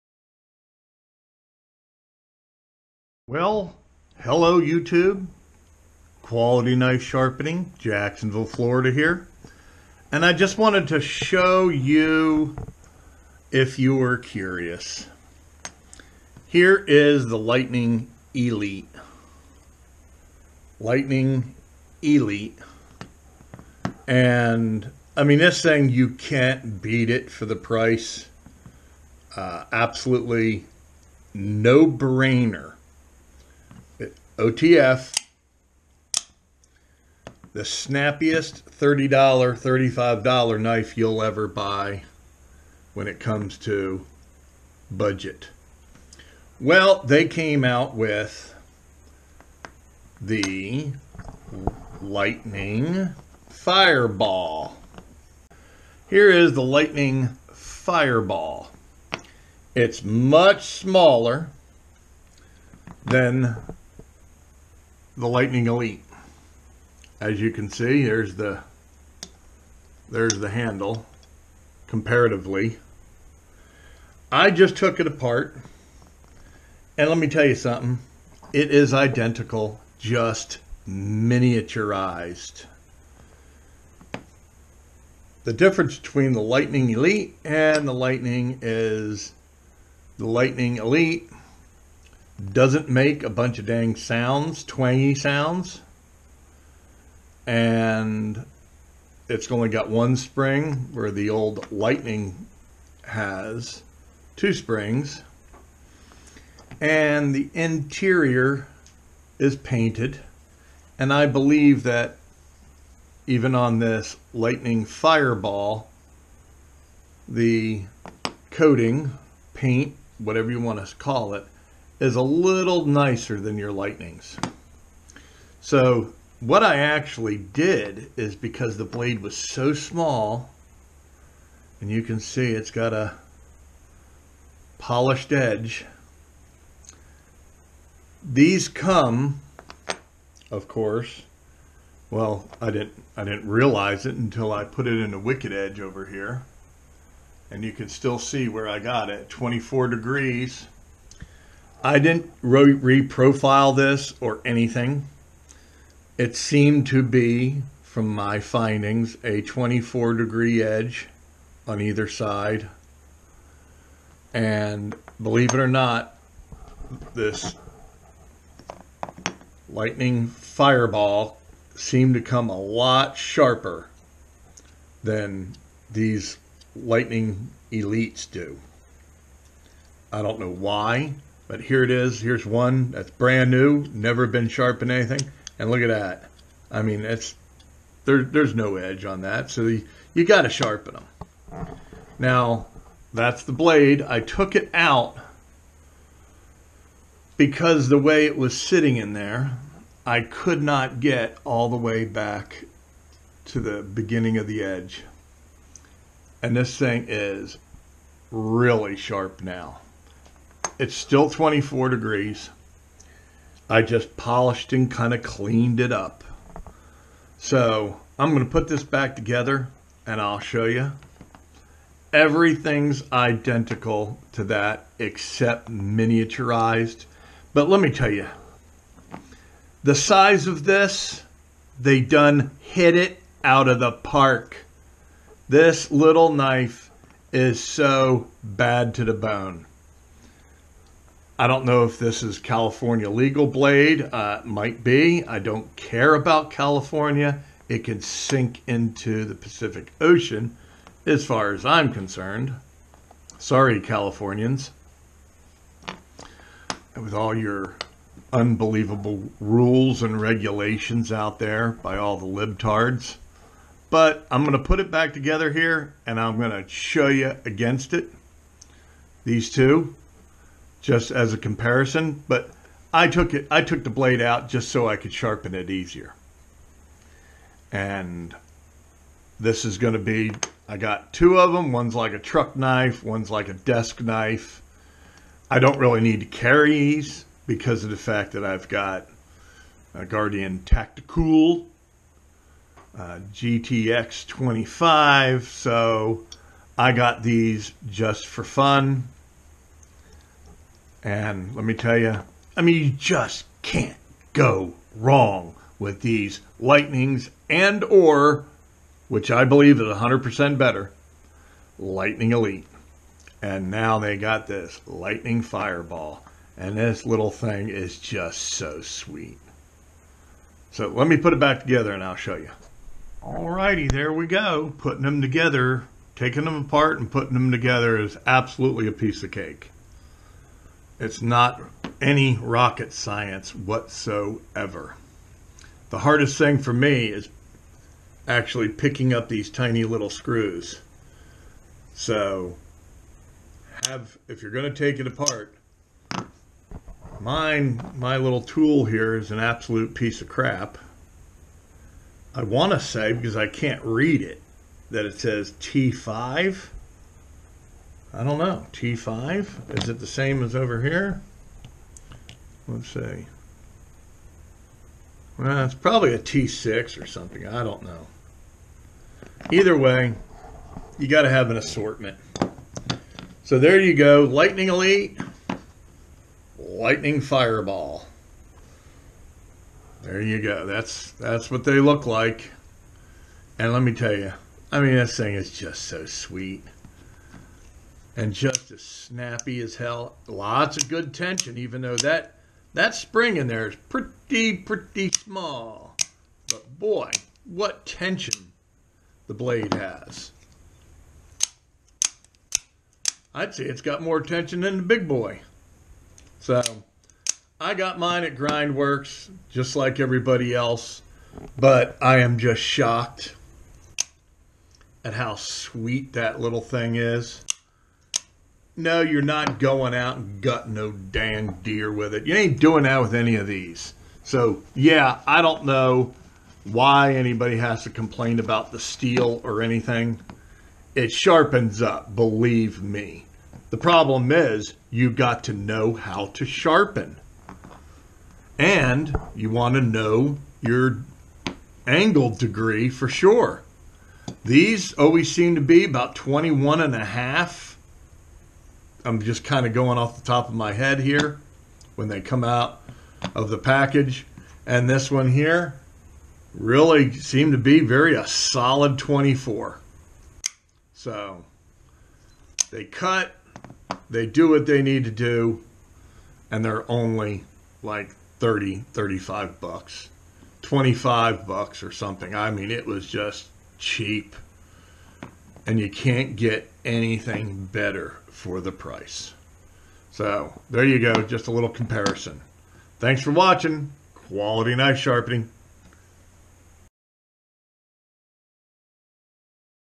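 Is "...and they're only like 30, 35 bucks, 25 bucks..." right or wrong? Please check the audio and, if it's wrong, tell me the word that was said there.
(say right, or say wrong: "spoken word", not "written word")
right.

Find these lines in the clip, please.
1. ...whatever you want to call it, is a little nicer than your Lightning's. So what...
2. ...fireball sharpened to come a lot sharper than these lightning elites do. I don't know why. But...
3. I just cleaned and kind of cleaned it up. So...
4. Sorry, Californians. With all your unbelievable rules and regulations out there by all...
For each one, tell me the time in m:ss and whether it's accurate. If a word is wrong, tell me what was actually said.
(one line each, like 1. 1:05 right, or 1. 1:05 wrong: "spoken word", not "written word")
1. 2:00 right
2. 2:50 wrong: "seemed", not "sharpened"
3. 3:33 wrong: "polished", not "cleaned"
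4. 4:13 right.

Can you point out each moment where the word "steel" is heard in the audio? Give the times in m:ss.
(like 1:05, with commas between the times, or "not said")
7:08.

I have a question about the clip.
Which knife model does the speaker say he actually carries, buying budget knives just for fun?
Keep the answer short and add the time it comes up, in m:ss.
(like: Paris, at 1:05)
Guardian Tactical GTX 25, at 4:50.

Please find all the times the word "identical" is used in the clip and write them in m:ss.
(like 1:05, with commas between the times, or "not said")
1:18, 3:43.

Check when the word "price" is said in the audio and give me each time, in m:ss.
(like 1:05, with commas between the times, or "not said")
0:27, 7:58.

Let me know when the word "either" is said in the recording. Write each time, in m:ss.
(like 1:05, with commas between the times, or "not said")
2:41, 6:09.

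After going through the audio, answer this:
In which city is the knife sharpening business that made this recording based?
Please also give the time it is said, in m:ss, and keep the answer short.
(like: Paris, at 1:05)
Jacksonville, Florida, at 0:07.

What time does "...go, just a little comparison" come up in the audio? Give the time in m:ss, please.
8:00.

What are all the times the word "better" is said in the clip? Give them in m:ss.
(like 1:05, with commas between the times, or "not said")
5:10, 7:57.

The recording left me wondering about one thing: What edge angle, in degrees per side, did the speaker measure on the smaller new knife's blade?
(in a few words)
24 degrees.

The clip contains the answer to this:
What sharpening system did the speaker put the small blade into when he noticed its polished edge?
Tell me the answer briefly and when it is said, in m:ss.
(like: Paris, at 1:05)
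Wicked Edge, at 2:25.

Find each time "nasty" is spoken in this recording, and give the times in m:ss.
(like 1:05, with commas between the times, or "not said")
not said.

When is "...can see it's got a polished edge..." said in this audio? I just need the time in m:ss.
2:12.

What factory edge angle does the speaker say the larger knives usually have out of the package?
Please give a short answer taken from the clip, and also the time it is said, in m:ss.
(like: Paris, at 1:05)
21.5 degrees, at 7:26.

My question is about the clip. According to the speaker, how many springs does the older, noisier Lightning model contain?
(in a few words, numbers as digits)
2.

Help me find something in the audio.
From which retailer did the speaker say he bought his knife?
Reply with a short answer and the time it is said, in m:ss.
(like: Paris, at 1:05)
Grindworks, at 6:48.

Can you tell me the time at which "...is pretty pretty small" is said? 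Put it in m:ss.
6:33.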